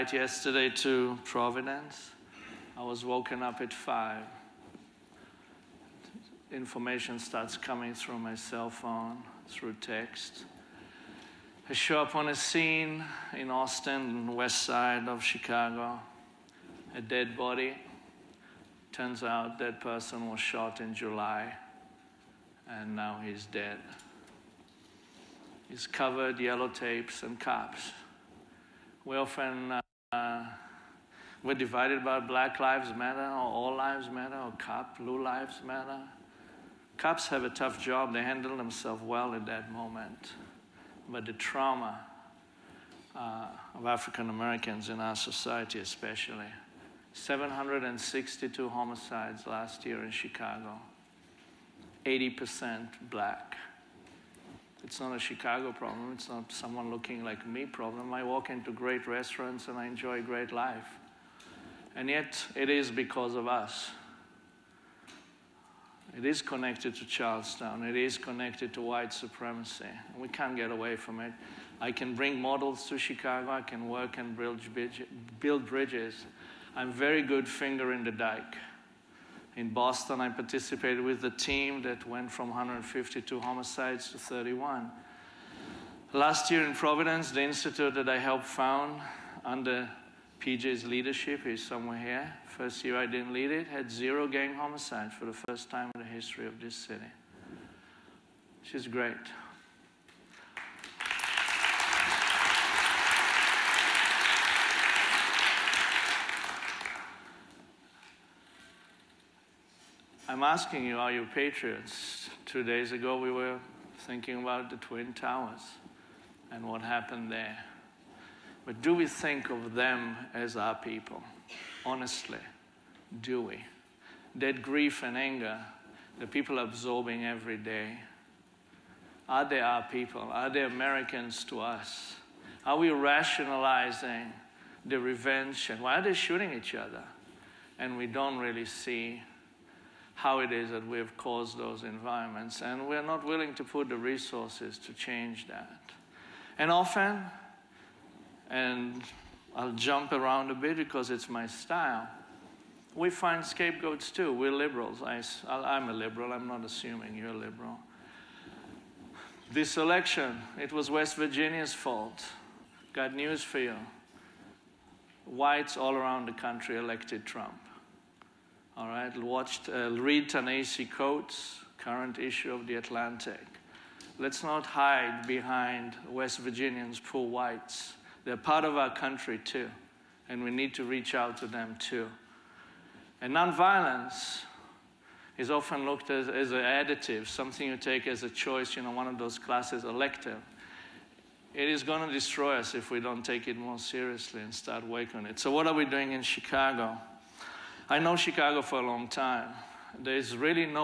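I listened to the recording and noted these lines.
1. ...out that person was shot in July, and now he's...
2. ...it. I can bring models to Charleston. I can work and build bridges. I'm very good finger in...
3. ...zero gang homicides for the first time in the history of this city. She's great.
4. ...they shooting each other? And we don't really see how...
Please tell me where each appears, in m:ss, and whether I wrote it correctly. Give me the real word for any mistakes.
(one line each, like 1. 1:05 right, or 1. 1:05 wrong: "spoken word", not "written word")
1. 0:19 right
2. 1:11 wrong: "Chicago", not "Charleston"
3. 1:33 right
4. 2:16 right.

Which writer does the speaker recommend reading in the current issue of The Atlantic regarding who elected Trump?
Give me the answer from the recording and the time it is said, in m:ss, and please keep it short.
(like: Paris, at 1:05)
Ta-Nehisi Coates, at 2:50.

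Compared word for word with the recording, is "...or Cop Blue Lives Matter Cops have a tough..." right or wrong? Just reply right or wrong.
right.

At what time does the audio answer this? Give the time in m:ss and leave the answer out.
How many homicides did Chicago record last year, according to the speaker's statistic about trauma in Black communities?
0:47.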